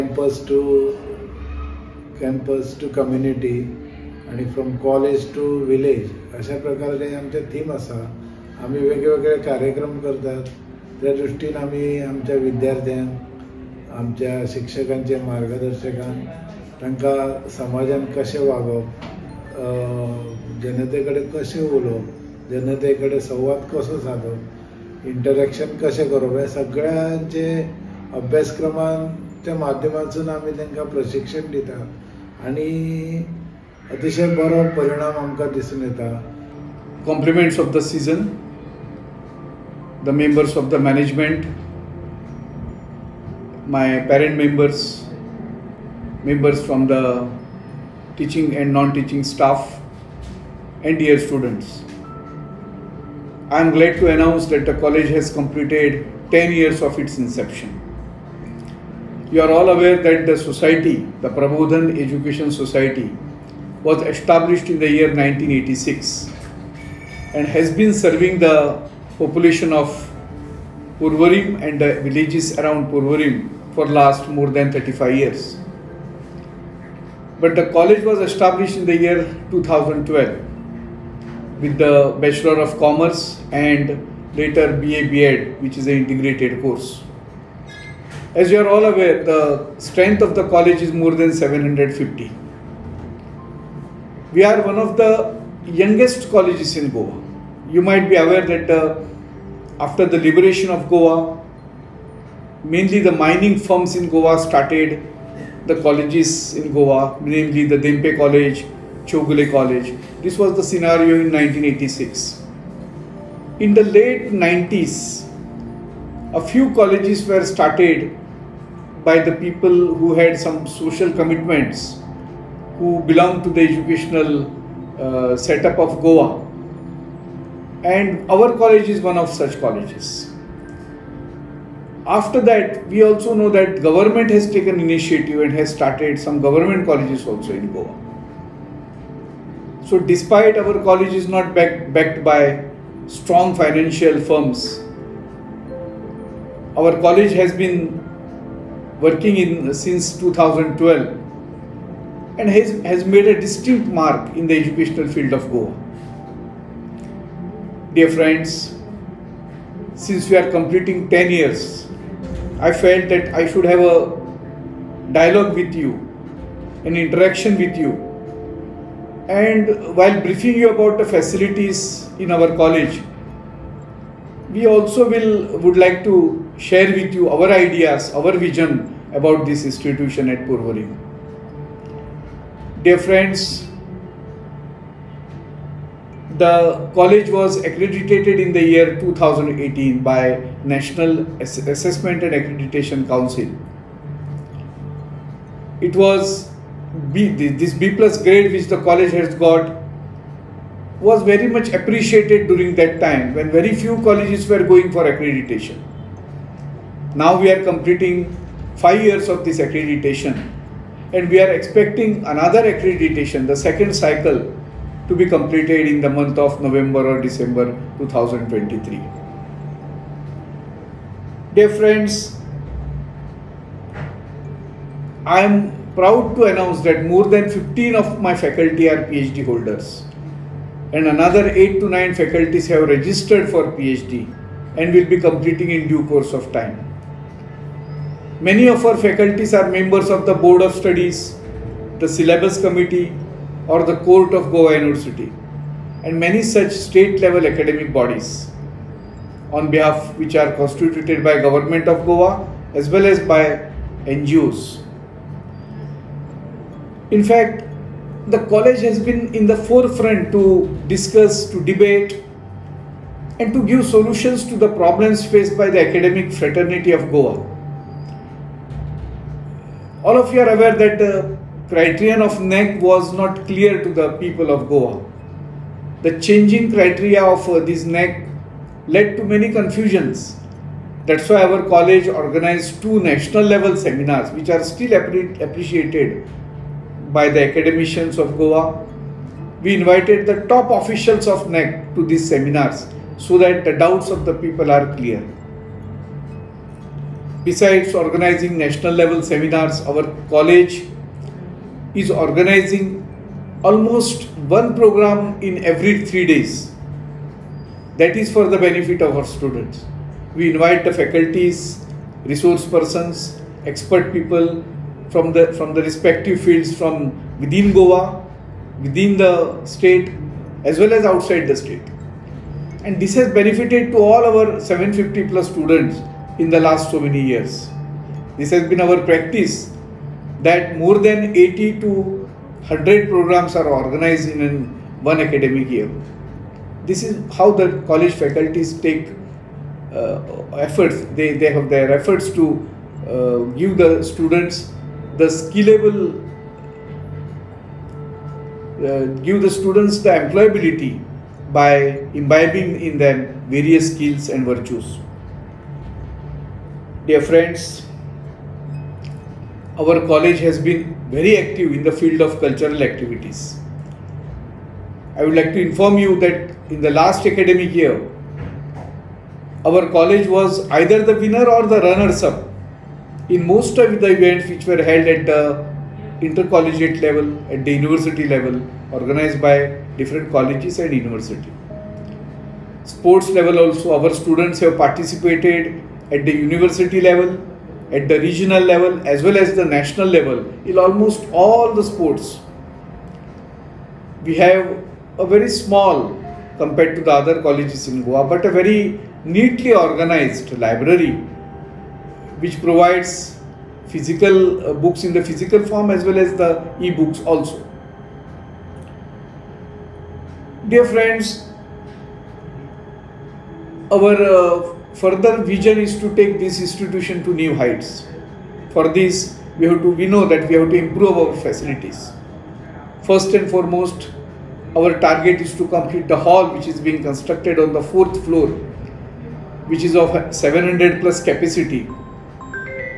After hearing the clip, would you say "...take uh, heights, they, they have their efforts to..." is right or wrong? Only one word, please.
wrong.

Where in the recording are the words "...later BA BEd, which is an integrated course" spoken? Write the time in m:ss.
1:24.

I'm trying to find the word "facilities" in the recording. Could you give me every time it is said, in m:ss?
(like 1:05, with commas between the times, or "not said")
2:51, 7:01.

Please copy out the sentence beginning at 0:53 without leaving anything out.
I am glad to announce that the college has completed 10 years of its inception.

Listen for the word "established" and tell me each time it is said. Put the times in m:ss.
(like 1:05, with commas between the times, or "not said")
1:04, 1:18.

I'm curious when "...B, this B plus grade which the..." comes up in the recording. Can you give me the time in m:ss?
3:17.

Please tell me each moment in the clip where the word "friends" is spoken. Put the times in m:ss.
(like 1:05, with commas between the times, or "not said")
2:38, 3:02, 3:41, 5:57, 6:50.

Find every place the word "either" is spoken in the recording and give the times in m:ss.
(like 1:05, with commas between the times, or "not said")
6:10.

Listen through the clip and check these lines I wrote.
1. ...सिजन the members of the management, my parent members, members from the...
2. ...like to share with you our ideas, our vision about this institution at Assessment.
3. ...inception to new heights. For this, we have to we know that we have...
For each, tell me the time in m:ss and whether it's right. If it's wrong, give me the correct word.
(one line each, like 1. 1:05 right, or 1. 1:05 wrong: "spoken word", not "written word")
1. 0:37 right
2. 2:55 wrong: "Purvari", not "Assessment"
3. 6:56 wrong: "institution", not "inception".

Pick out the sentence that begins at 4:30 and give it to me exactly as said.
All of you are aware that the uh, criterion of NAAC was not clear to the people of Goa.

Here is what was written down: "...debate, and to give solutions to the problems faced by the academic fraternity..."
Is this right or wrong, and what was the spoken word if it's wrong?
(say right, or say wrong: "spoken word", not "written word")
right.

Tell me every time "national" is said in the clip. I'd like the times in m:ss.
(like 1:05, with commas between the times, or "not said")
3:10, 4:42, 4:58, 6:29.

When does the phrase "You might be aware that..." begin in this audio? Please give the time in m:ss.
1:37.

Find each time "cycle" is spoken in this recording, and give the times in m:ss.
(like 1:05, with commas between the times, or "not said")
3:33.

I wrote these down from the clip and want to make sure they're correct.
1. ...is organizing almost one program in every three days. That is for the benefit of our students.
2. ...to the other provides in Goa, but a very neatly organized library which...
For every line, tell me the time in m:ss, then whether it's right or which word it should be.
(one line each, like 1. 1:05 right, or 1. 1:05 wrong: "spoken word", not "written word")
1. 5:02 right
2. 6:36 wrong: "colleges", not "provides".